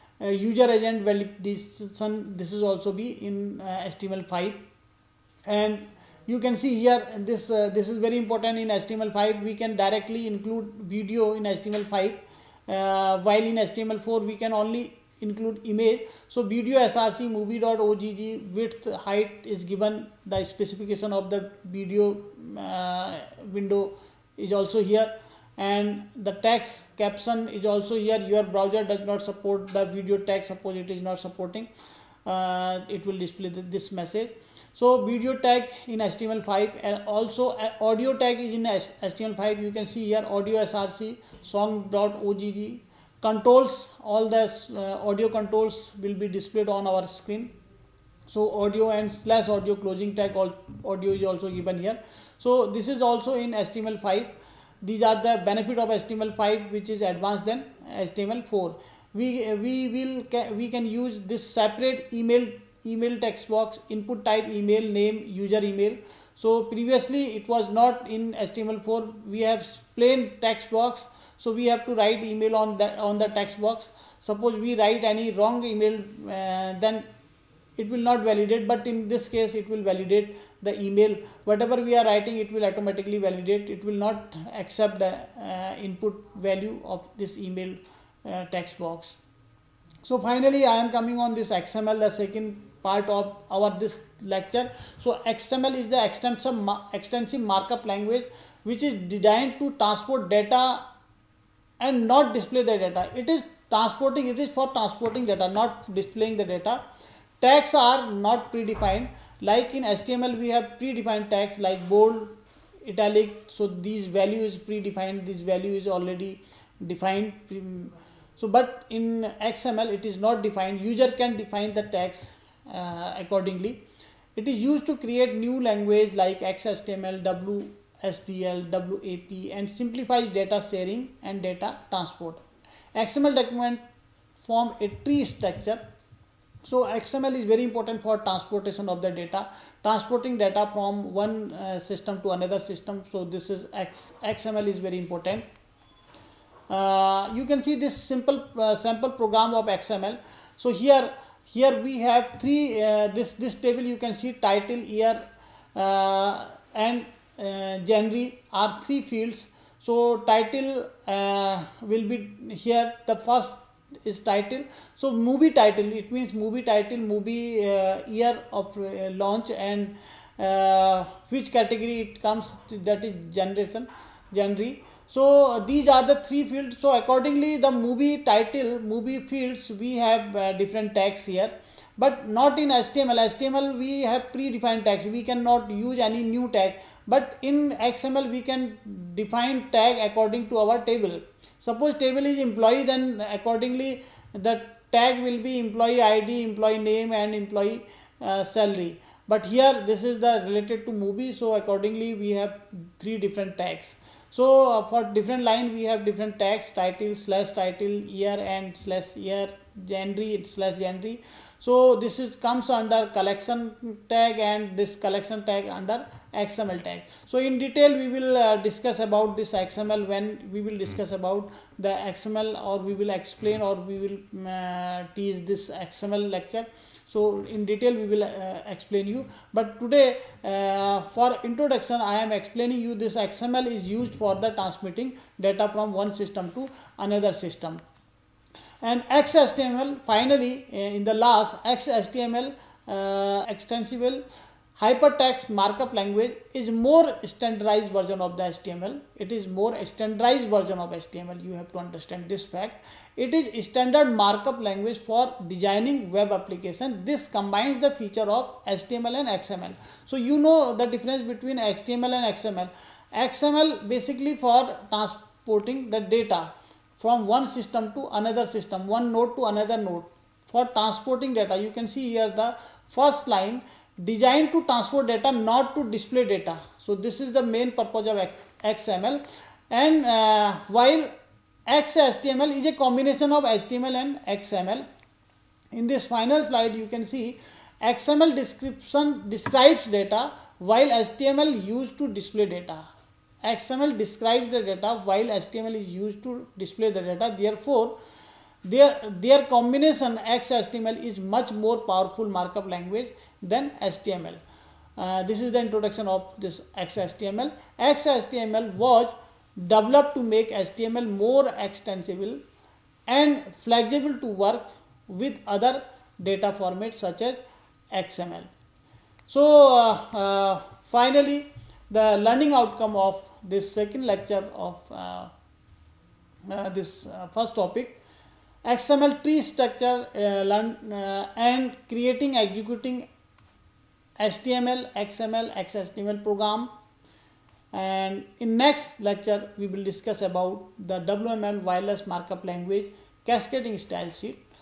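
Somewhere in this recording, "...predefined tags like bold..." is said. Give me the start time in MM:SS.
01:50.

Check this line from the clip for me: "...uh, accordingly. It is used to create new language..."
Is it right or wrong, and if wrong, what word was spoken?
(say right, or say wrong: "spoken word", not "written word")
right.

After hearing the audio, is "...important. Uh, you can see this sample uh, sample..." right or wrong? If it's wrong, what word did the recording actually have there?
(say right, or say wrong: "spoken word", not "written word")
wrong: "simple", not "sample".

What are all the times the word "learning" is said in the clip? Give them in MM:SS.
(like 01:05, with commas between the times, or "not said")
05:22.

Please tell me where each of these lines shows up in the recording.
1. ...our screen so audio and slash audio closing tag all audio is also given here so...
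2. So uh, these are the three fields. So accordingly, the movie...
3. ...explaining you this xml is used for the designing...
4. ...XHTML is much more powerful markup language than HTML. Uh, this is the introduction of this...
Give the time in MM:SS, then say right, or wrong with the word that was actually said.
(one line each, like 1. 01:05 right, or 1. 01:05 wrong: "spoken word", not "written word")
1. 00:46 right
2. 02:55 right
3. 03:52 wrong: "transmitting", not "designing"
4. 05:00 right.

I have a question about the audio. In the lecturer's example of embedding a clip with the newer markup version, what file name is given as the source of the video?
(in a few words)
movie.ogg.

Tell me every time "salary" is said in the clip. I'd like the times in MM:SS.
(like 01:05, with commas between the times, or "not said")
03:18.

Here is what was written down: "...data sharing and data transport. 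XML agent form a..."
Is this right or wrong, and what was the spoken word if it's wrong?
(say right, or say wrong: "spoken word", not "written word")
wrong: "document", not "agent".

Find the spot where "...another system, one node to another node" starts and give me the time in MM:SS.
04:28.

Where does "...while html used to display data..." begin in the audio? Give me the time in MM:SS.
04:50.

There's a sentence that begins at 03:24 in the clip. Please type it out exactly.
So uh, for different line we have different tags title slash title year and slash year genre slash genre.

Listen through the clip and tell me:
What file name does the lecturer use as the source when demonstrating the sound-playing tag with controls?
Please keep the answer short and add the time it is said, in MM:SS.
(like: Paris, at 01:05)
song.ogg, at 00:41.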